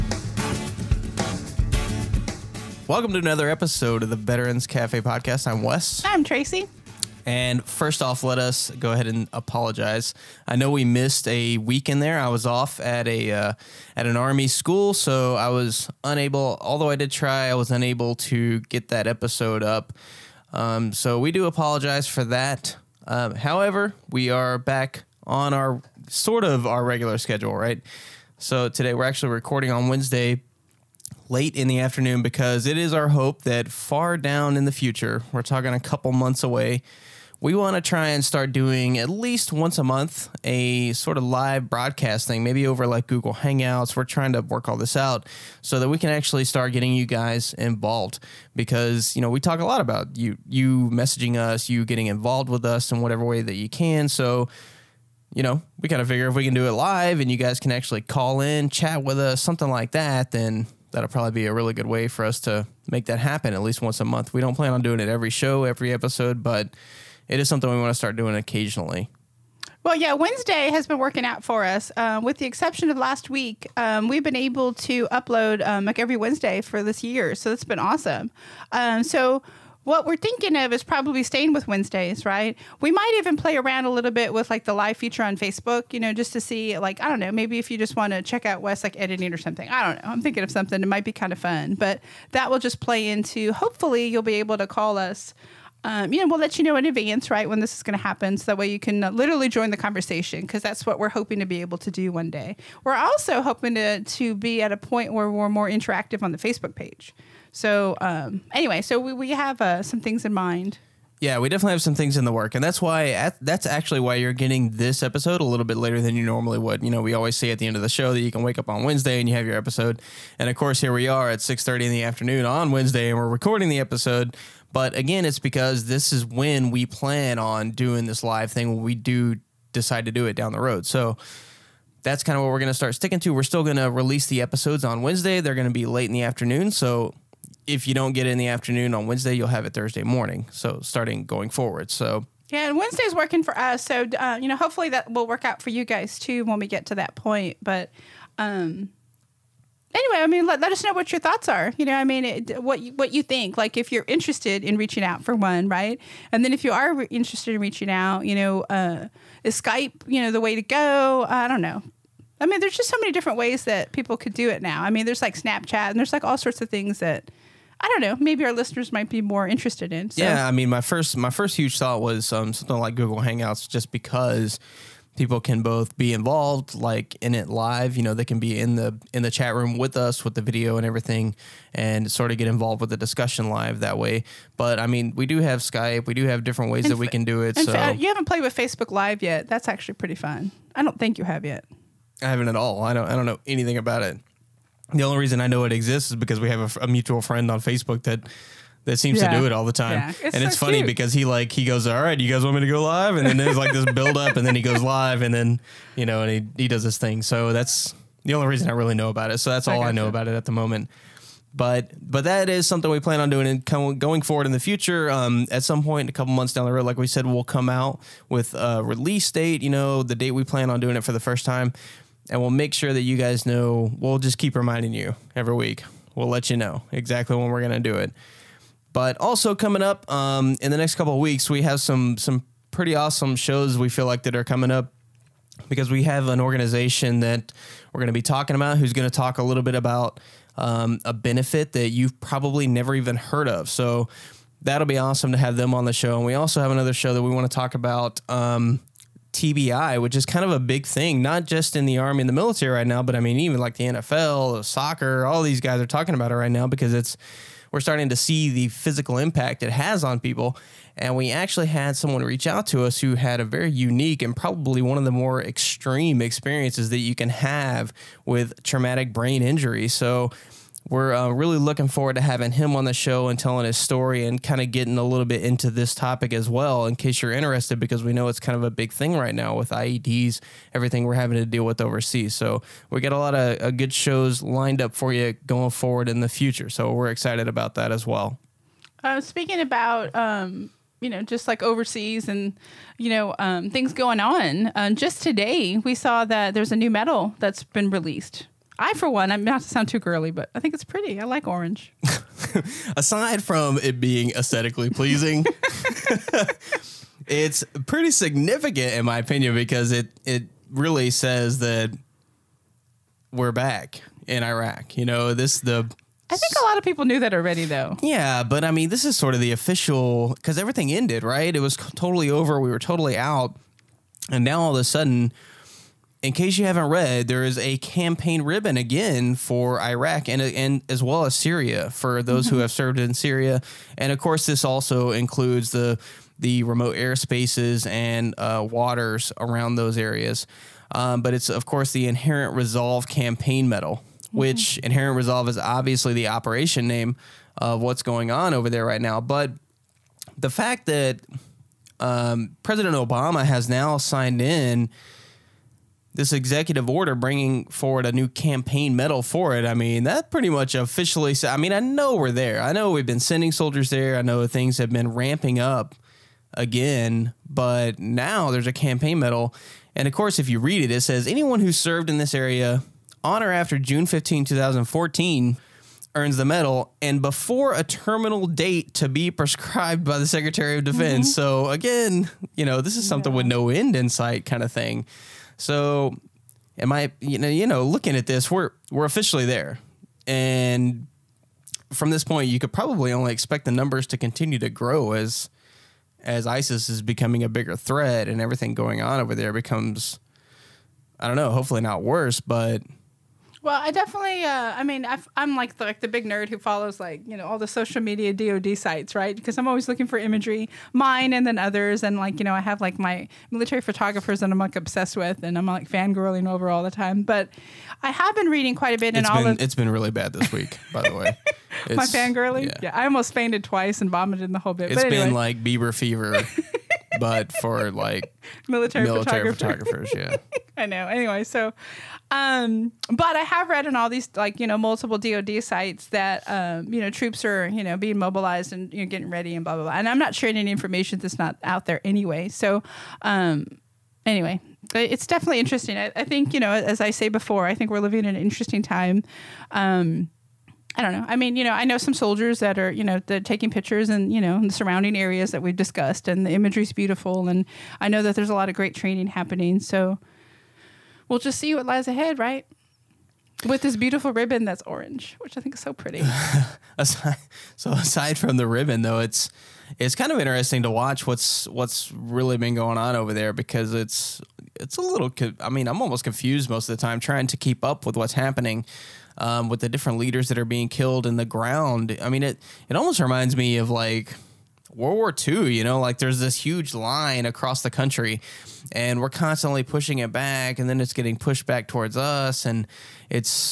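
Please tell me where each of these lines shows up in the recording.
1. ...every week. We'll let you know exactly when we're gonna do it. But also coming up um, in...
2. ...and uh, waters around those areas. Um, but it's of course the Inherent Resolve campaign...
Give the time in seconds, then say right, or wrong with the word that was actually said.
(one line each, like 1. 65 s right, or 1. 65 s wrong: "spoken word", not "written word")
1. 225 s right
2. 337 s right.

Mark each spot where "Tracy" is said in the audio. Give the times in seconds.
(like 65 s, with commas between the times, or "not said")
6 s.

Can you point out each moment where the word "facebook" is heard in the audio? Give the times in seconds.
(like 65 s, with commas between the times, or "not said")
85 s, 106 s, 188 s, 197 s.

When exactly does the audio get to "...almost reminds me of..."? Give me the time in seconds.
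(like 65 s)
482 s.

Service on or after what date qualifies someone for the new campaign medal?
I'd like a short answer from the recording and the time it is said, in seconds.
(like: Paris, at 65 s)
June 15, 2014, at 373 s.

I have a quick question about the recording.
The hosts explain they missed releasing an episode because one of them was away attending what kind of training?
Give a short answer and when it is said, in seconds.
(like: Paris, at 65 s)
army school, at 14 s.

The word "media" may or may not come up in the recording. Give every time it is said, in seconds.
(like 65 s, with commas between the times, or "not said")
408 s.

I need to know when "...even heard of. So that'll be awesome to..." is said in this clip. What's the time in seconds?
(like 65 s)
242 s.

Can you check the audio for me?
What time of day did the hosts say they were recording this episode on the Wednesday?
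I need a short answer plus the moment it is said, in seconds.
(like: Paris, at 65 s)
6:30, at 121 s.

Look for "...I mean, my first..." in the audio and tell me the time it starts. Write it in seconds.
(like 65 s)
170 s.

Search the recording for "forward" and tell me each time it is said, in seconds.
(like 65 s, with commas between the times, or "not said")
141 s, 214 s, 271 s, 285 s, 357 s.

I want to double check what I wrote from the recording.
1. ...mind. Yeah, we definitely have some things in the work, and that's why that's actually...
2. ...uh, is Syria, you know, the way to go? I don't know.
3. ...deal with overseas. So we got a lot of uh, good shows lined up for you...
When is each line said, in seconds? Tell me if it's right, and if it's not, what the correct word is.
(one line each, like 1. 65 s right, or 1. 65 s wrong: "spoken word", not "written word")
1. 110 s right
2. 158 s wrong: "Skype", not "Syria"
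3. 281 s right.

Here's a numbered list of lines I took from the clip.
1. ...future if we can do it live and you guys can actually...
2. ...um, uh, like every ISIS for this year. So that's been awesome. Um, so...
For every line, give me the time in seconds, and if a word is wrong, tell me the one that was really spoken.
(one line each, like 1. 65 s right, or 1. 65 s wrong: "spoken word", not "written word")
1. 56 s wrong: "figure", not "future"
2. 75 s wrong: "Wednesday", not "ISIS".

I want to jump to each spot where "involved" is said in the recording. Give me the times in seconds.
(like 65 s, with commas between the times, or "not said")
47 s, 52 s, 176 s, 182 s.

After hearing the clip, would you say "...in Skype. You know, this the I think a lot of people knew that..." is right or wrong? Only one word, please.
wrong.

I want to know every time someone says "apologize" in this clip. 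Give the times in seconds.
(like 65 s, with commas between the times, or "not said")
9 s, 21 s.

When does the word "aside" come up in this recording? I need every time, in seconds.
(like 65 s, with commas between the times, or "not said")
302 s, 467 s.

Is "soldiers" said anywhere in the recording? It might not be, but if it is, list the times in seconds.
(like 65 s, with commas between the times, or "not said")
363 s, 452 s.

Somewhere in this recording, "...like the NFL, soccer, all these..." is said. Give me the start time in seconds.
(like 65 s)
253 s.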